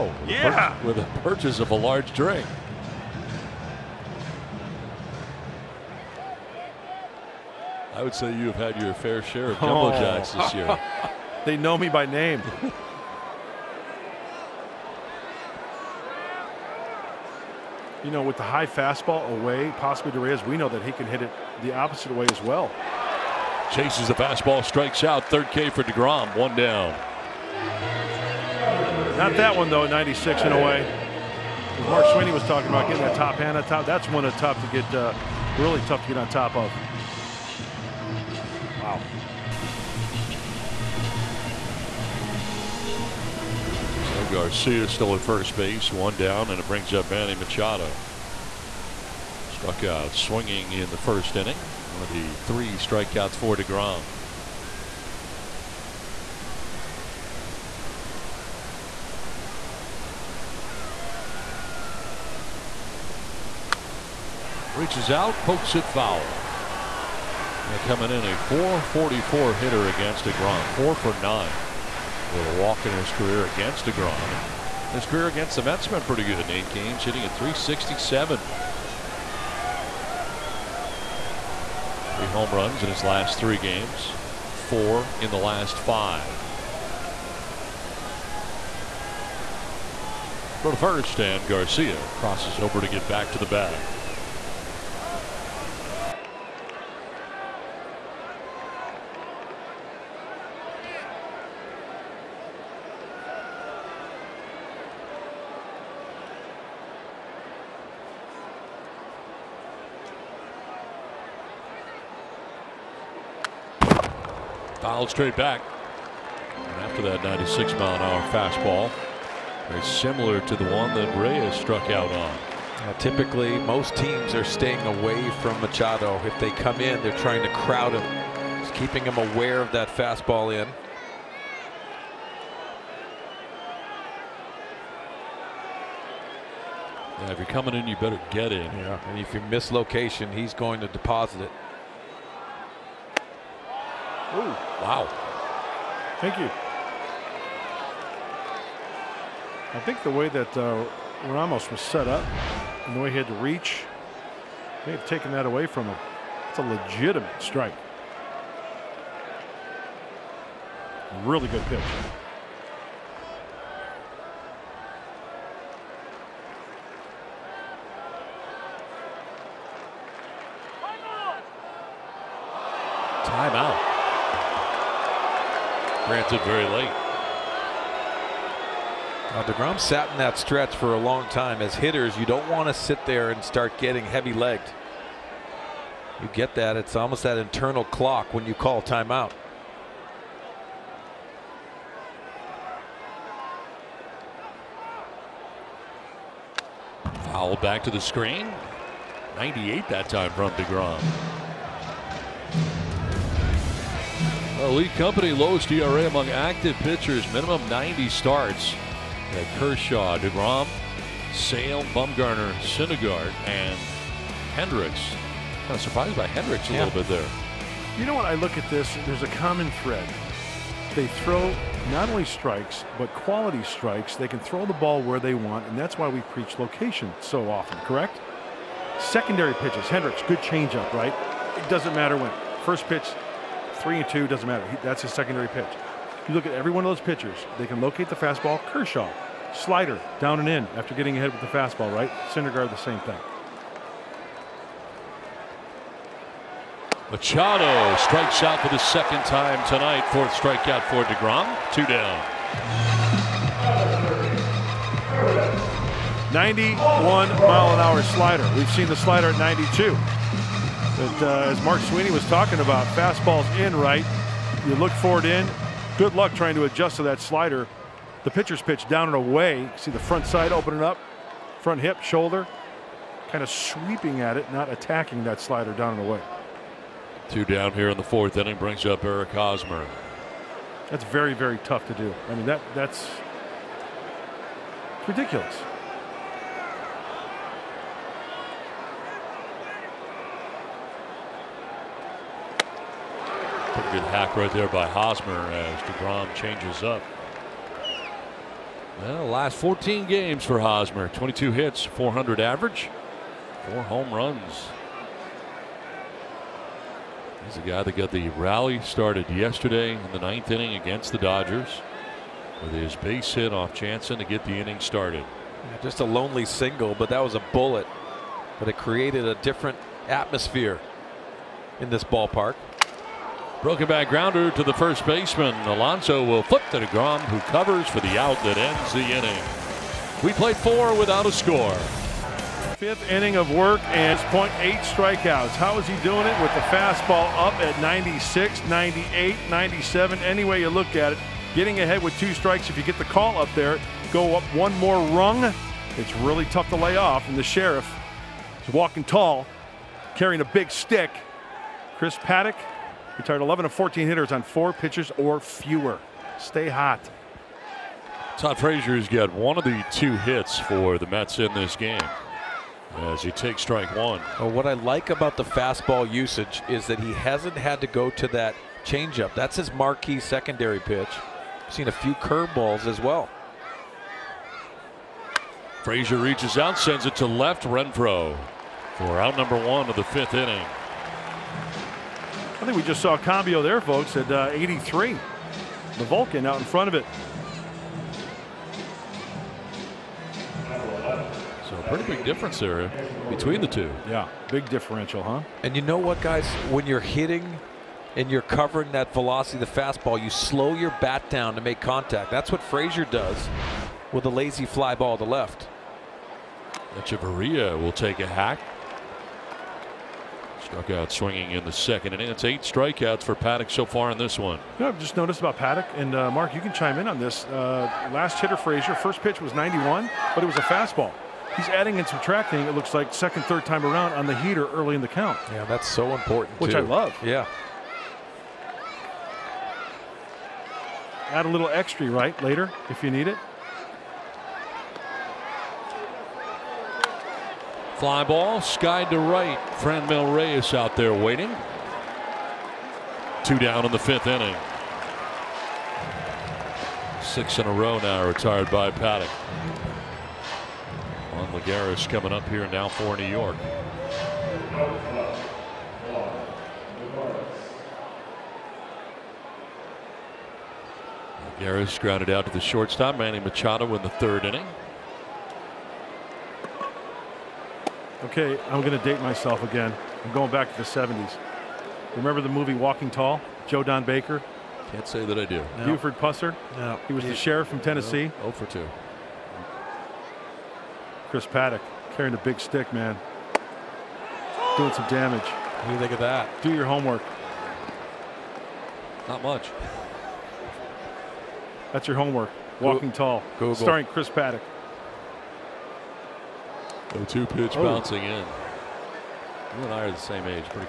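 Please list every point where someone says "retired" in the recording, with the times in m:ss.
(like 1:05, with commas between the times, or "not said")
5:53, 7:28.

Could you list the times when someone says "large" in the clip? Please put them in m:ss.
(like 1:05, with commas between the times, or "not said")
0:01.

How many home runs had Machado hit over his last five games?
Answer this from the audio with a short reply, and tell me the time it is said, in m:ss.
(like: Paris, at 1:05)
4, at 1:24.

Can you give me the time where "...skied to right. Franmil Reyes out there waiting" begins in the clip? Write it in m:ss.
7:18.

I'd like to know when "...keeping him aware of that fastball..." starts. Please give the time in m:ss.
2:08.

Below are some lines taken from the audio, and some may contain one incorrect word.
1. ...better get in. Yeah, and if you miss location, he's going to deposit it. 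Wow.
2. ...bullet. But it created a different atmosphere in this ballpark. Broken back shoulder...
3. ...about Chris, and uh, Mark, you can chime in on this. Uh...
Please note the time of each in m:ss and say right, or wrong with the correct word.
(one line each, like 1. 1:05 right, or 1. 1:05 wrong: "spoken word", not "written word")
1. 2:17 right
2. 5:17 wrong: "grounder", not "shoulder"
3. 6:55 wrong: "Paddack", not "Chris".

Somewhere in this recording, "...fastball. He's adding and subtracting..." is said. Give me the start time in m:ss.
7:00.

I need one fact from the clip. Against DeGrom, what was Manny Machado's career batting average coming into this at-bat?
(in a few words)
.444.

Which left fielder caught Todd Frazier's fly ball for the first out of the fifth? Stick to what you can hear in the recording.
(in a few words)
Renfroe.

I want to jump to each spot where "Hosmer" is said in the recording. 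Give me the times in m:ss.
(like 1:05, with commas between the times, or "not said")
4:39, 4:54, 5:00.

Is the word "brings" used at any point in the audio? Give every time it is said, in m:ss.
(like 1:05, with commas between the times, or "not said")
0:46, 4:38.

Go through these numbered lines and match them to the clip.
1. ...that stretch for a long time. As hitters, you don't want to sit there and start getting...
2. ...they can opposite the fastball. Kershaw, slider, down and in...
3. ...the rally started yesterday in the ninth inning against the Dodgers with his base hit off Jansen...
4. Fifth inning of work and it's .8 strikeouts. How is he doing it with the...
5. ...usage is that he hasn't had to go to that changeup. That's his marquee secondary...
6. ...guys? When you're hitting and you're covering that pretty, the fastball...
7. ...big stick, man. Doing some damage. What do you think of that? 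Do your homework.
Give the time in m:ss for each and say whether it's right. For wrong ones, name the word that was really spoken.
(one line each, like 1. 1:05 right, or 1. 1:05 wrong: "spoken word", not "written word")
1. 3:00 right
2. 3:57 wrong: "locate", not "opposite"
3. 5:08 right
4. 5:32 right
5. 6:06 right
6. 6:36 wrong: "velocity", not "pretty"
7. 8:02 right.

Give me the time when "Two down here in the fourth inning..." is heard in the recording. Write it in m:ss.
4:37.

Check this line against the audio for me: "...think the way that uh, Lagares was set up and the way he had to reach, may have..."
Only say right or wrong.
wrong.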